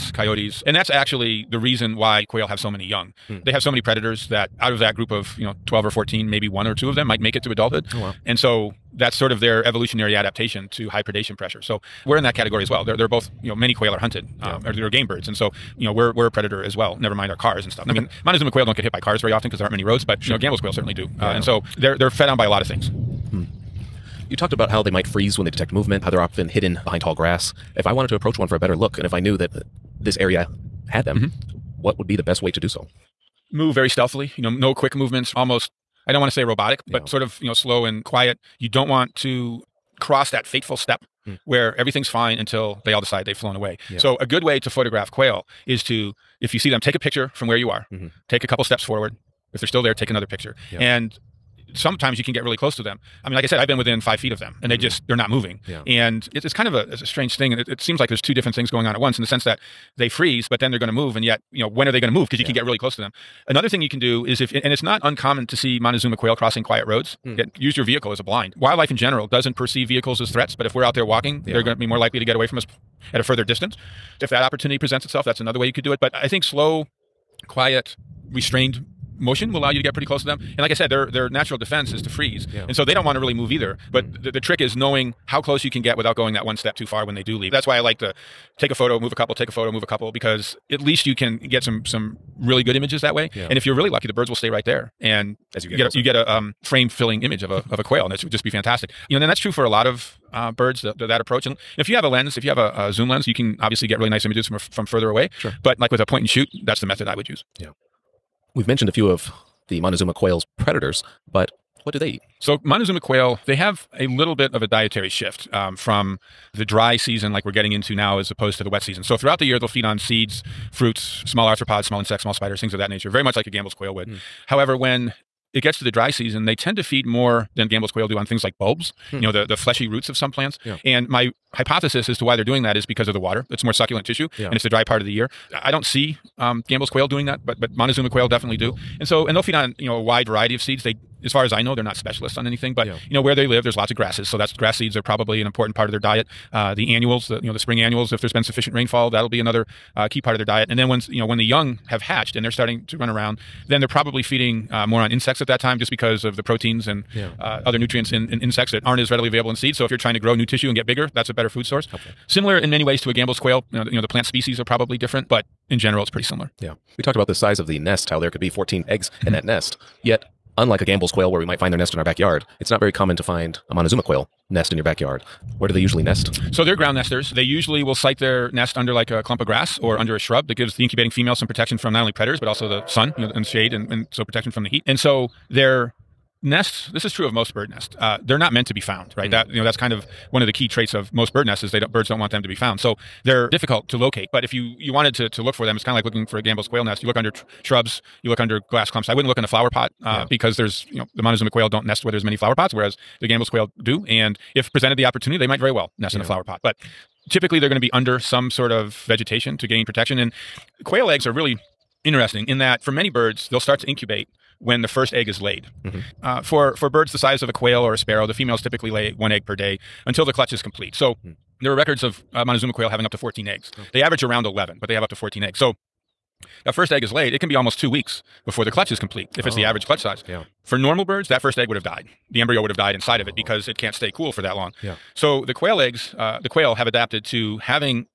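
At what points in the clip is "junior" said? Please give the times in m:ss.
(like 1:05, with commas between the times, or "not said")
not said.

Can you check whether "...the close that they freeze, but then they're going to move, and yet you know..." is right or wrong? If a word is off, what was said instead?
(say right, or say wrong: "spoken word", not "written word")
wrong: "sense", not "close".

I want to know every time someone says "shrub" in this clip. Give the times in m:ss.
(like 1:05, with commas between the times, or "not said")
3:00, 3:17.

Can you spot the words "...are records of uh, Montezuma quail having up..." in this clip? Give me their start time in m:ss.
3:41.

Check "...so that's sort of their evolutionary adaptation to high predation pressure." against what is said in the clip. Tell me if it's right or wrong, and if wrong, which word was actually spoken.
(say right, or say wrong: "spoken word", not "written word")
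right.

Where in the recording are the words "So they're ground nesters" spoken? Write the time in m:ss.
2:56.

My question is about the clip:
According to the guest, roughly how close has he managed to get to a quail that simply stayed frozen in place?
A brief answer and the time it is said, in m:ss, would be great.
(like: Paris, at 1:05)
5 feet, at 0:54.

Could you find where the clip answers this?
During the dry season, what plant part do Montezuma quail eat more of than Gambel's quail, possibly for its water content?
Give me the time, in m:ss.
2:08.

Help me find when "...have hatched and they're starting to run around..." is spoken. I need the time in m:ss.
2:31.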